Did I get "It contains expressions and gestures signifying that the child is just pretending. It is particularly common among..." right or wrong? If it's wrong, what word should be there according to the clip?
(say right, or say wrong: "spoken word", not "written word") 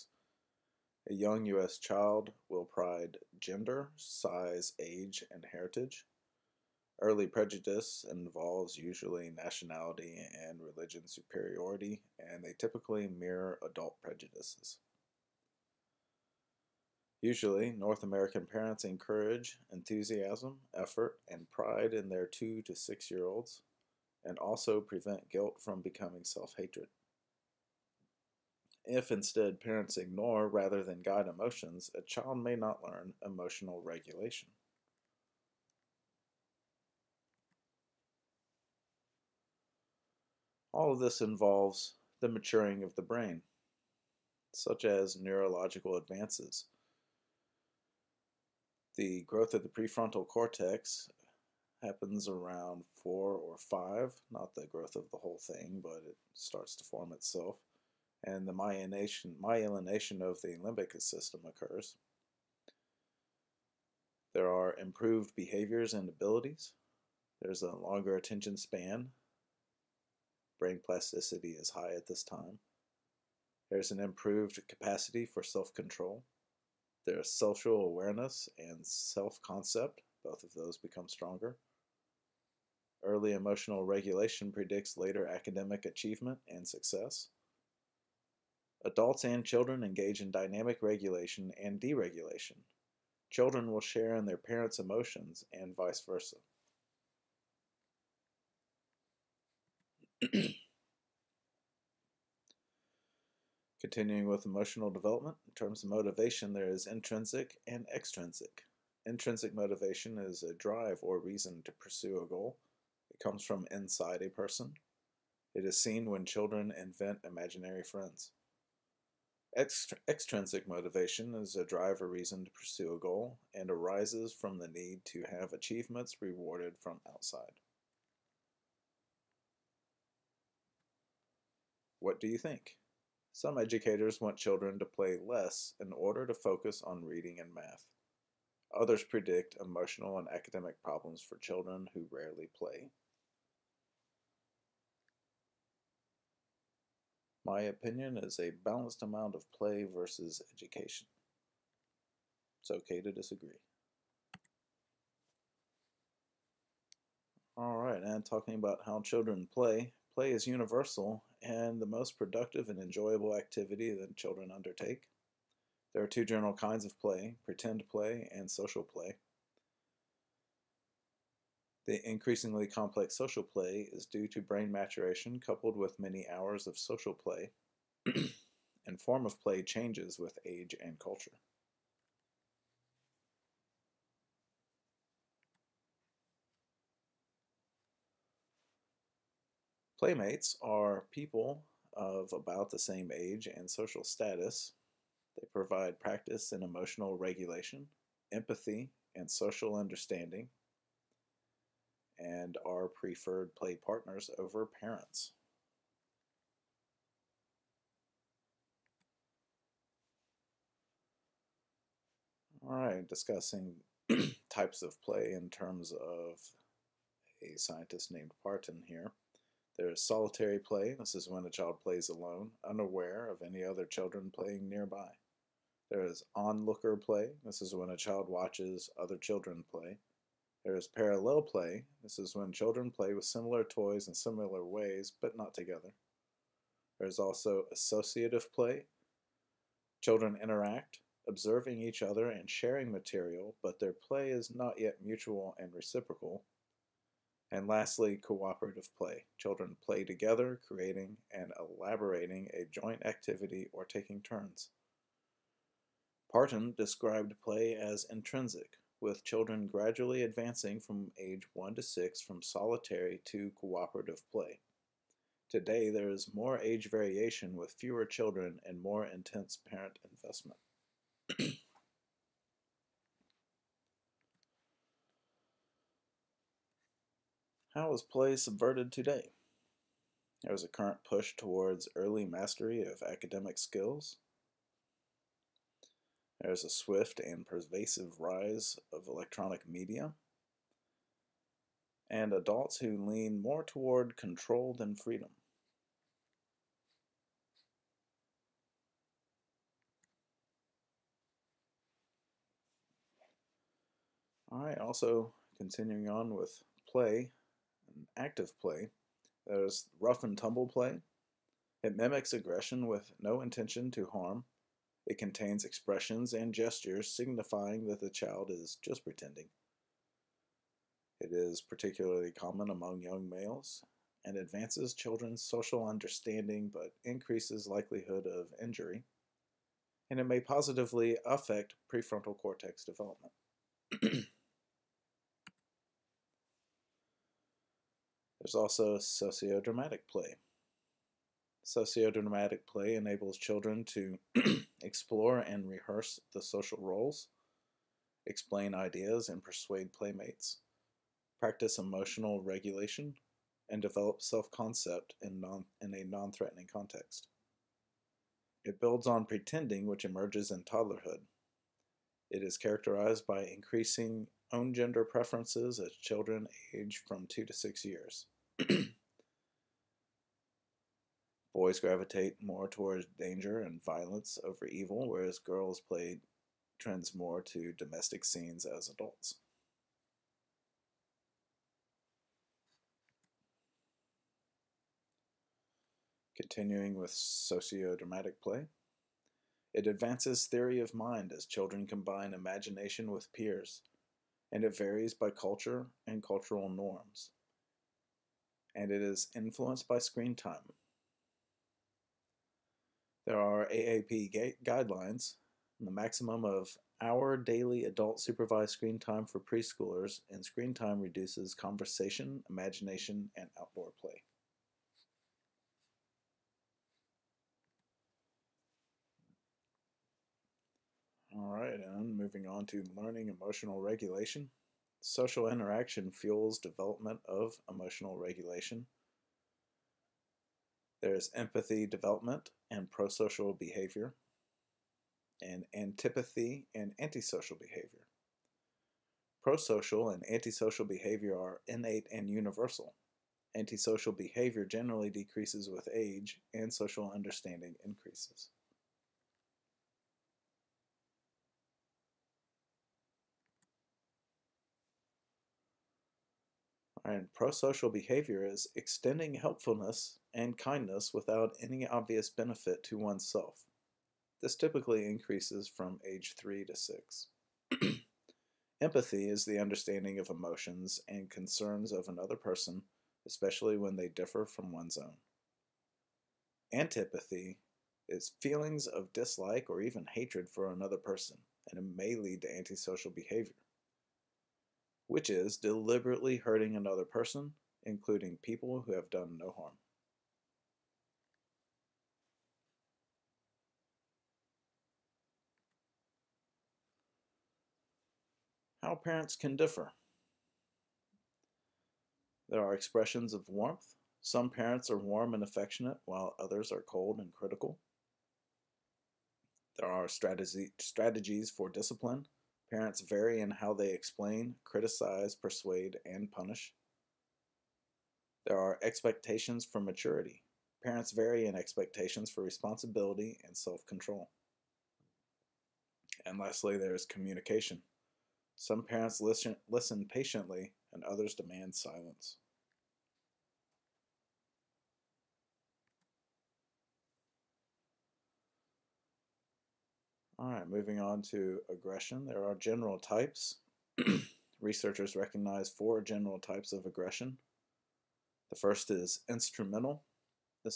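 right.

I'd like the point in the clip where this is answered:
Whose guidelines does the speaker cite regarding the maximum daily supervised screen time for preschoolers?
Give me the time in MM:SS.
06:43.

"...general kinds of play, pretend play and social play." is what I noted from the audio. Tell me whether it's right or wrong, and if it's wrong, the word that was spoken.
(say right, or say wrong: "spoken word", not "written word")
right.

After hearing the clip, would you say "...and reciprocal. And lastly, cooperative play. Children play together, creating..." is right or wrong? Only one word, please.
right.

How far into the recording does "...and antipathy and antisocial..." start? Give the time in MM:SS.
07:15.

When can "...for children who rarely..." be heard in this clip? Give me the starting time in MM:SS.
02:21.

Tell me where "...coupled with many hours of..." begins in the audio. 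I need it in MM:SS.
02:55.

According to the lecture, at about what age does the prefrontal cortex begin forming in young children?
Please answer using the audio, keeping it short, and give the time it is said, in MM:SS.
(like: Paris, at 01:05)
4 or 5, at 00:53.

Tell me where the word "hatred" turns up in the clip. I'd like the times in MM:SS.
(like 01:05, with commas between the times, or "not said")
00:26, 08:00.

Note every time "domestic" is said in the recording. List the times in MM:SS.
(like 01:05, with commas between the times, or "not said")
06:17.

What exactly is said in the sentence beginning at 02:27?
My opinion is a balanced amount of play versus education.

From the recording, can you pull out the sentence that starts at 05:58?
It builds on pretending, which emerges in toddlerhood.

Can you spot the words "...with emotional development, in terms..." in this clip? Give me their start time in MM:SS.
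01:44.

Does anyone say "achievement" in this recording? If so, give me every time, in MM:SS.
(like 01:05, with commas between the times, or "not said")
01:25, 02:05.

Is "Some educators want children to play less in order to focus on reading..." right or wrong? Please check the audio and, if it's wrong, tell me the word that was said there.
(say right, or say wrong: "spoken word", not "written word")
right.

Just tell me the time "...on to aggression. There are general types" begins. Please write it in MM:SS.
09:01.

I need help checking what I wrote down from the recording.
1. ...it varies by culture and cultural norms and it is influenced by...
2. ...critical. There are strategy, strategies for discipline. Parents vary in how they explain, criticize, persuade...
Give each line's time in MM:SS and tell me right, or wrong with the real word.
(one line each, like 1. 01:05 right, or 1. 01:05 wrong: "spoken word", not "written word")
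1. 06:34 right
2. 08:27 right.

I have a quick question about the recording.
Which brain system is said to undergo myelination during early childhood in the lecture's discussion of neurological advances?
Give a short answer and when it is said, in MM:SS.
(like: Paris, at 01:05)
limbic system, at 01:00.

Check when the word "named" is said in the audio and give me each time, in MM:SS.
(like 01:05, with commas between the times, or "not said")
03:38.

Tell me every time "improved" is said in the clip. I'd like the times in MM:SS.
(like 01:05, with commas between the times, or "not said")
01:04, 01:13.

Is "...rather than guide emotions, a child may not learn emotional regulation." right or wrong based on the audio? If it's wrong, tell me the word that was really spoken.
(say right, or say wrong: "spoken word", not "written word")
right.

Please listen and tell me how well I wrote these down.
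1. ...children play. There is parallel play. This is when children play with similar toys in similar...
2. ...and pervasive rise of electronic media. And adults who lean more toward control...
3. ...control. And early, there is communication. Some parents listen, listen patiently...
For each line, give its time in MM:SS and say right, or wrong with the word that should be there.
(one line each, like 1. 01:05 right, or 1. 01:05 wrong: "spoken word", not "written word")
1. 03:49 right
2. 04:47 right
3. 08:43 wrong: "lastly", not "early".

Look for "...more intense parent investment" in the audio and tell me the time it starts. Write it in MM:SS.
04:28.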